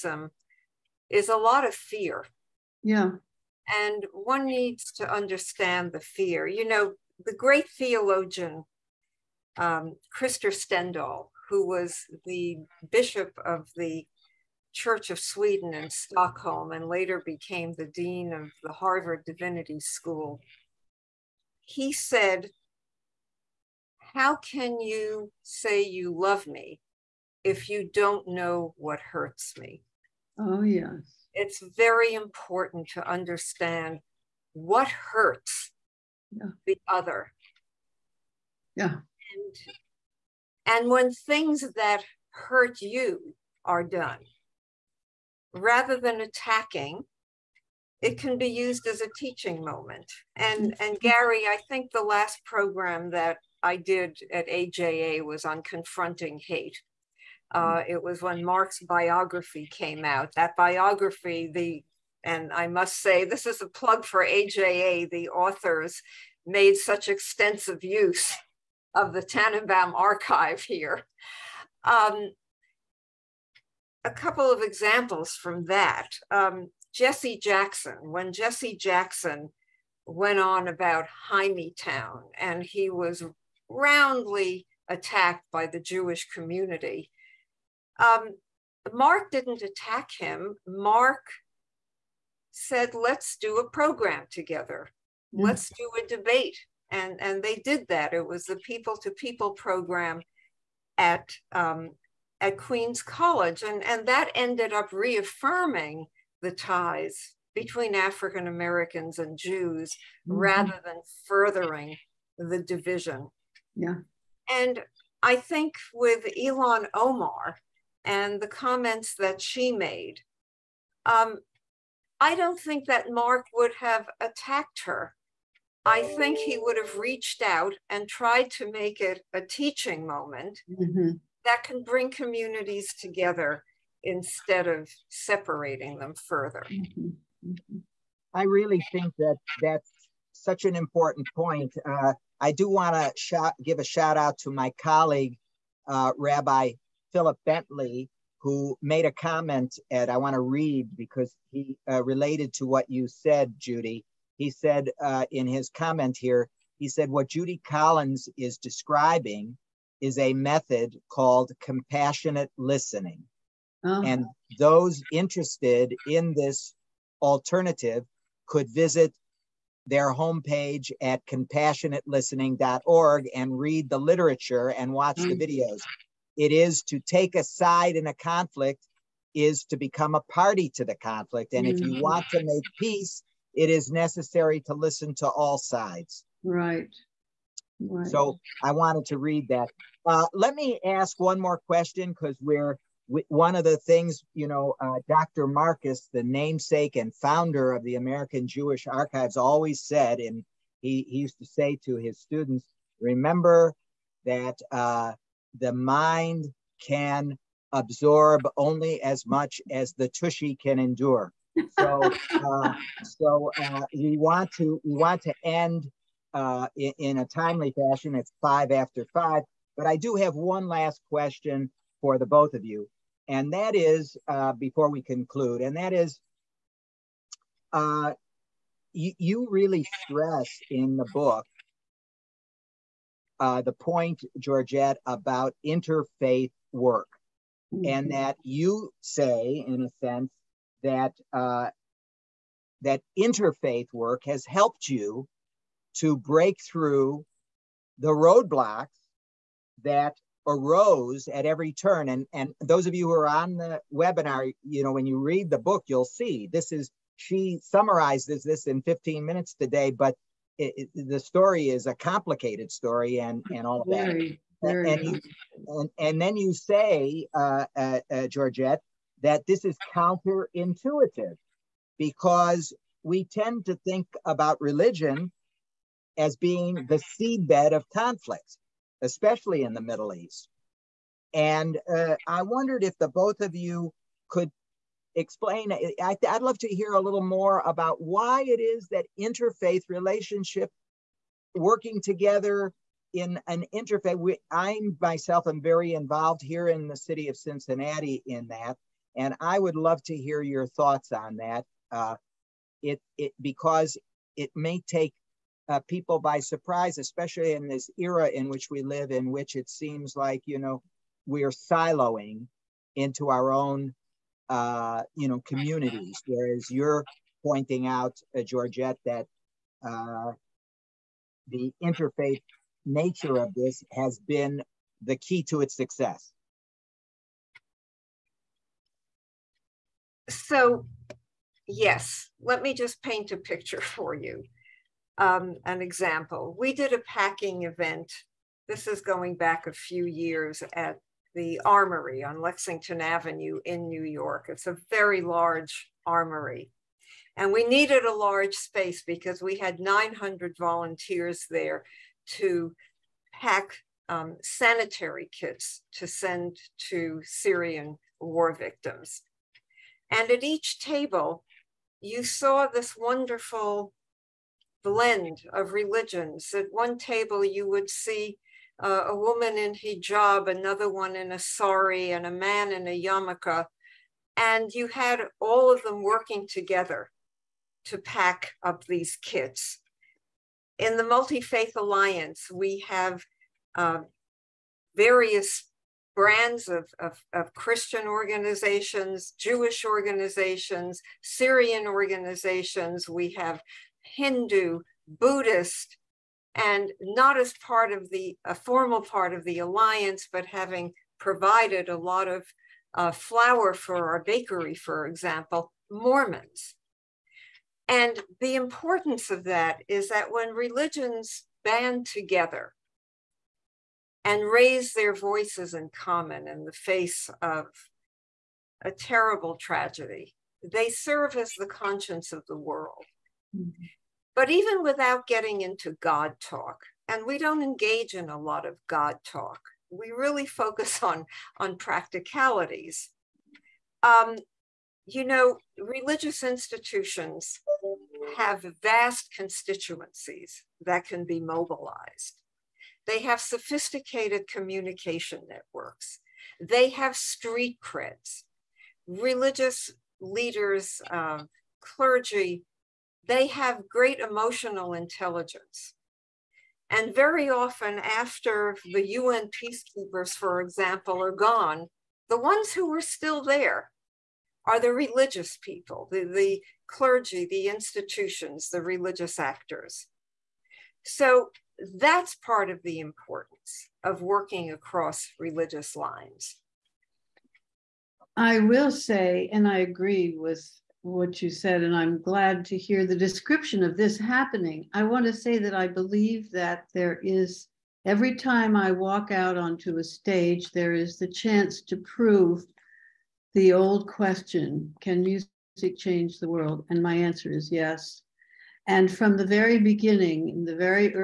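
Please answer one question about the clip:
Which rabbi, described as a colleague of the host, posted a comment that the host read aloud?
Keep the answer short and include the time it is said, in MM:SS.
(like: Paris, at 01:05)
Philip Bentley, at 02:27.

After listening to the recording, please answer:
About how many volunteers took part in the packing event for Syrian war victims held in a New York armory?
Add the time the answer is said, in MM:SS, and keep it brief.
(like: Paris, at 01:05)
900, at 05:49.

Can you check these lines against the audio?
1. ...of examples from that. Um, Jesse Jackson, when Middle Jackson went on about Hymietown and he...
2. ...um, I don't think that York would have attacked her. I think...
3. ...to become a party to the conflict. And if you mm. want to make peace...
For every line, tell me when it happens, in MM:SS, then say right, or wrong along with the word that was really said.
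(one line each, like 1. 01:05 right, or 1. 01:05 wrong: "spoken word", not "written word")
1. 01:14 wrong: "Jesse", not "Middle"
2. 02:01 wrong: "Marc", not "York"
3. 02:59 right.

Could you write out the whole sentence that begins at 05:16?
Whereas you're pointing out, uh, Georgette, that uh, the interfaith nature of this has been the key to its success.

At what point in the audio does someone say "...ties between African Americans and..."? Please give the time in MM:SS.
01:46.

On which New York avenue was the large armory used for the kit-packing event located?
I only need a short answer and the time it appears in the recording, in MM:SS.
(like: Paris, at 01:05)
Lexington Avenue, at 05:42.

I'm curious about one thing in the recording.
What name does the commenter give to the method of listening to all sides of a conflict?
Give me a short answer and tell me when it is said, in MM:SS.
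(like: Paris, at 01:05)
compassionate listening, at 02:41.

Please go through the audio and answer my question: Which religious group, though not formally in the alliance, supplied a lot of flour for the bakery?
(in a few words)
Mormons.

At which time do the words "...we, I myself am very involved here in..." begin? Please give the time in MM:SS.
04:54.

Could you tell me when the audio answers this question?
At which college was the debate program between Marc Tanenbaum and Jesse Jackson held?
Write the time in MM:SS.
01:42.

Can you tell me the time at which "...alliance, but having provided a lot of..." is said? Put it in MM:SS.
06:39.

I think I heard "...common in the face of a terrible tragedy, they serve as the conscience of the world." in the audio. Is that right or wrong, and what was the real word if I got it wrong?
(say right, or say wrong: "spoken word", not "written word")
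right.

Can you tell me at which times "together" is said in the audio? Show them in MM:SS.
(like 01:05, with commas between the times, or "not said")
01:34, 02:12, 04:52, 06:16, 06:52.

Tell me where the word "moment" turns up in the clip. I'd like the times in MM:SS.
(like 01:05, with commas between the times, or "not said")
00:49, 02:10.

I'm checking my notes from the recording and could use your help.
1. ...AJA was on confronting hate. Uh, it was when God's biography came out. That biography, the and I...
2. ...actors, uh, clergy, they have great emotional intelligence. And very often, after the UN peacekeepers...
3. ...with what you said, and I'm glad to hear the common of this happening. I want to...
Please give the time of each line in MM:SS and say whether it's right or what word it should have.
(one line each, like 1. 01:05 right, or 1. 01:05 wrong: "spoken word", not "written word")
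1. 00:54 wrong: "Marc", not "God"
2. 07:30 wrong: "leaders", not "actors"
3. 08:00 wrong: "description", not "common".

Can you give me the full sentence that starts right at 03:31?
So, uh, so uh, we want to we want to end uh, in, in a timely fashion.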